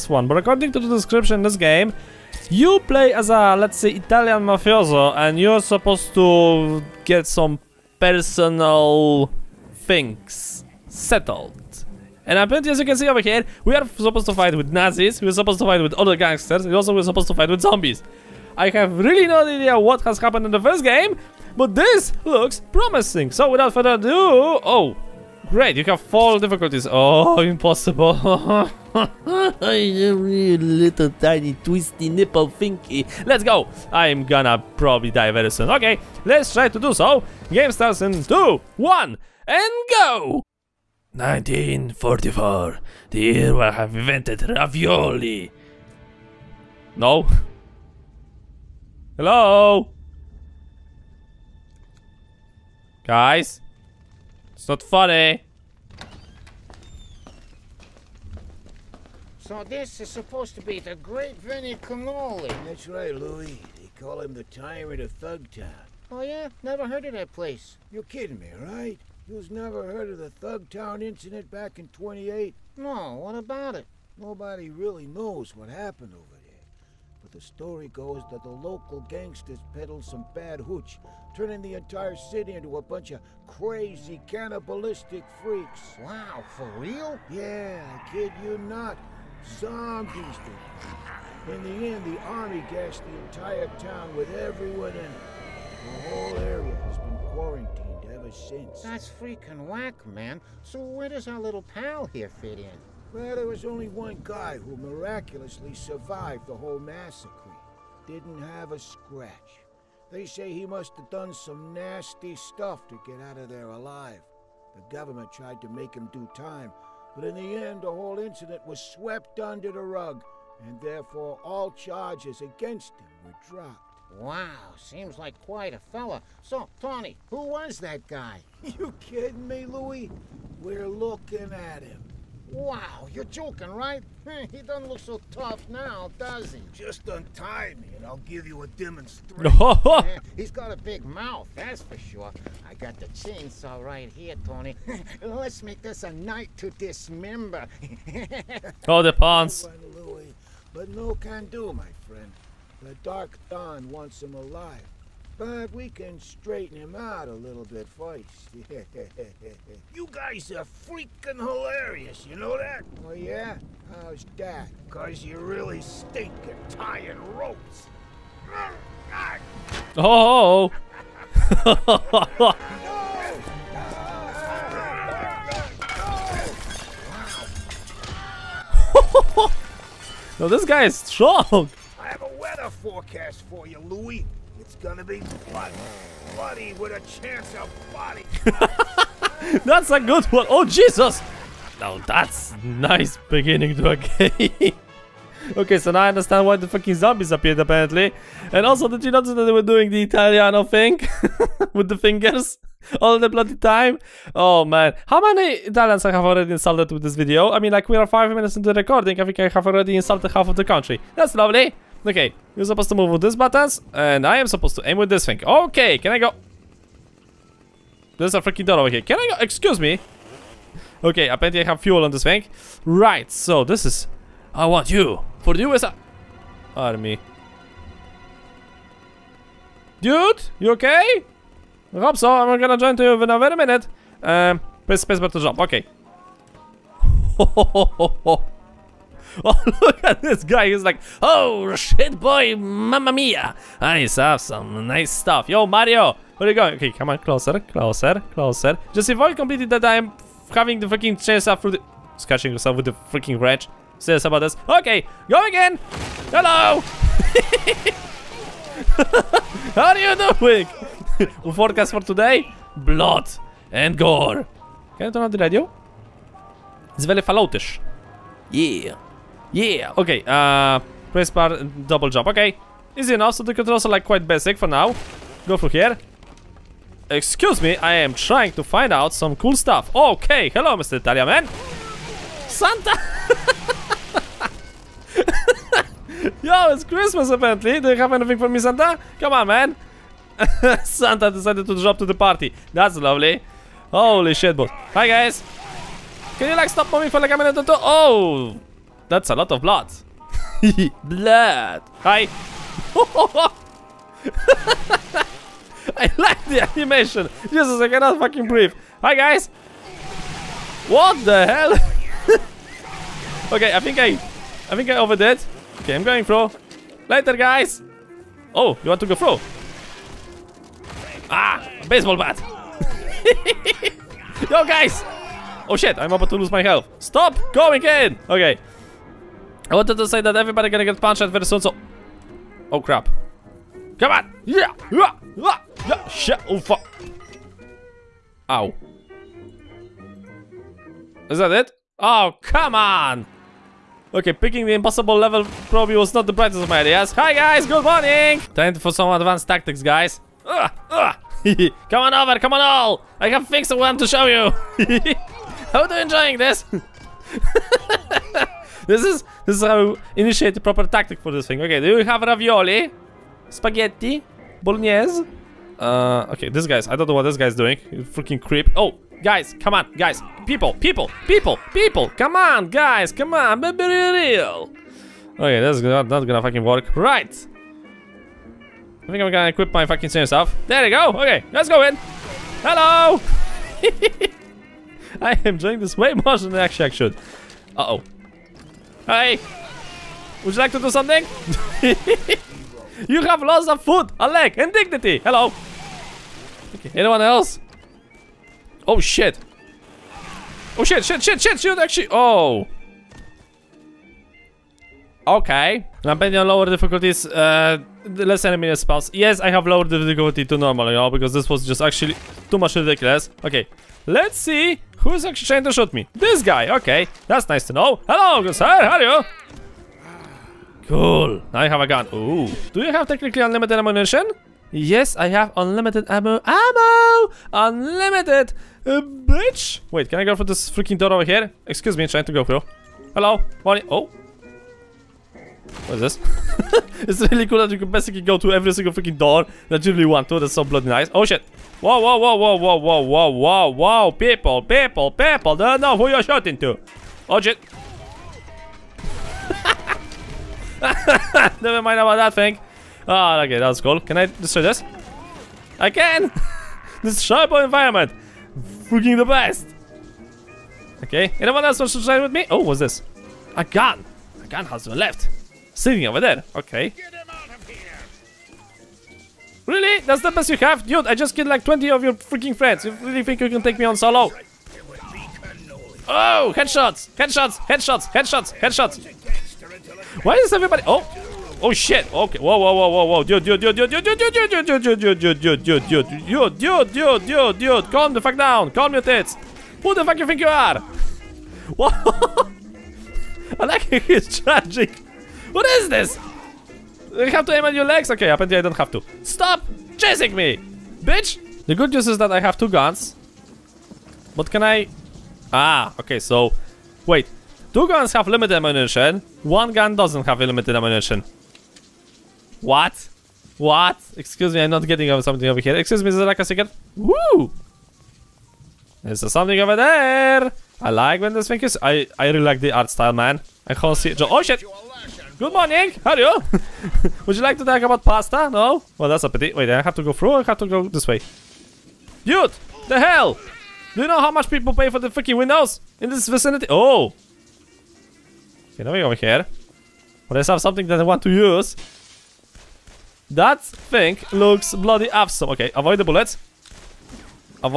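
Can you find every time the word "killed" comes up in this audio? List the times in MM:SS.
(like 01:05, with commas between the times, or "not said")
07:51.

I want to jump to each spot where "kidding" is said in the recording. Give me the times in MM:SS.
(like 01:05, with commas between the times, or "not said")
01:08, 02:08.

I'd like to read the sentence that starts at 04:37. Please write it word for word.
Excuse me, I am trying to find out some cool stuff.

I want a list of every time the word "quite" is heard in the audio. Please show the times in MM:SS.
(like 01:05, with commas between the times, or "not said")
02:05, 04:34.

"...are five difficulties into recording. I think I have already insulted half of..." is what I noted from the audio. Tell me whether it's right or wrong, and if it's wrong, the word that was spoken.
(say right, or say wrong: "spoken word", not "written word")
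wrong: "minutes", not "difficulties".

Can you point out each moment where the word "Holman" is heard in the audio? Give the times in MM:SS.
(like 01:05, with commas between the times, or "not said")
not said.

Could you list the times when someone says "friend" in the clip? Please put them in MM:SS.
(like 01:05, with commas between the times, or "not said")
02:32, 07:52.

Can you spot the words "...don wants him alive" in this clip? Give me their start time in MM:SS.
02:33.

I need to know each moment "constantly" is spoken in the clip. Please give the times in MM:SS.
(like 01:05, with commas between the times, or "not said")
not said.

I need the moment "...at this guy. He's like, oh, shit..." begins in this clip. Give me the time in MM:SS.
04:00.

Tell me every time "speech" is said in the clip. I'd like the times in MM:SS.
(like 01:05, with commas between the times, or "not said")
not said.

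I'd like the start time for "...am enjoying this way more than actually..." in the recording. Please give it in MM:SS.
06:25.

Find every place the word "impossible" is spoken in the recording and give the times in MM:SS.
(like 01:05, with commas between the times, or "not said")
00:27, 05:44.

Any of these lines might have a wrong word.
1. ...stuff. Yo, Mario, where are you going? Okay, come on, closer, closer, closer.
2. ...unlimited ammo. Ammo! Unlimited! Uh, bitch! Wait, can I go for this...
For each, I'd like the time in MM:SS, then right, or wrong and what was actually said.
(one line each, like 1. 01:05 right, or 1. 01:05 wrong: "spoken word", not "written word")
1. 04:05 right
2. 07:05 right.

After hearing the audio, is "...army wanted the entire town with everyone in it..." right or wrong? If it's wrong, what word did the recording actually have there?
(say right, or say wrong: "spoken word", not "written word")
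wrong: "gassed", not "wanted".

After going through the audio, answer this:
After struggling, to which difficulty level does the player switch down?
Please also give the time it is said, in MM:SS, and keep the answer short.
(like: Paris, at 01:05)
normal, at 06:50.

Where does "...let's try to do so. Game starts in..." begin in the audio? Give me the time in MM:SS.
00:36.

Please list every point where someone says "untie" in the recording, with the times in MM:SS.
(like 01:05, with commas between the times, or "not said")
02:17.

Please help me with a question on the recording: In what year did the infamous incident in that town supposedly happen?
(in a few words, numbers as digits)
1928.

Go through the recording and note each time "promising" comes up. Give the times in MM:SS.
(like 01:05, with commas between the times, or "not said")
00:22.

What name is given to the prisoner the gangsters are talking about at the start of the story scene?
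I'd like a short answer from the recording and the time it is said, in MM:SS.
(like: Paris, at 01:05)
Vinnie Cannoli, at 01:01.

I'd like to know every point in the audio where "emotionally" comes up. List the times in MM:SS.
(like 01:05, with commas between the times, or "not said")
not said.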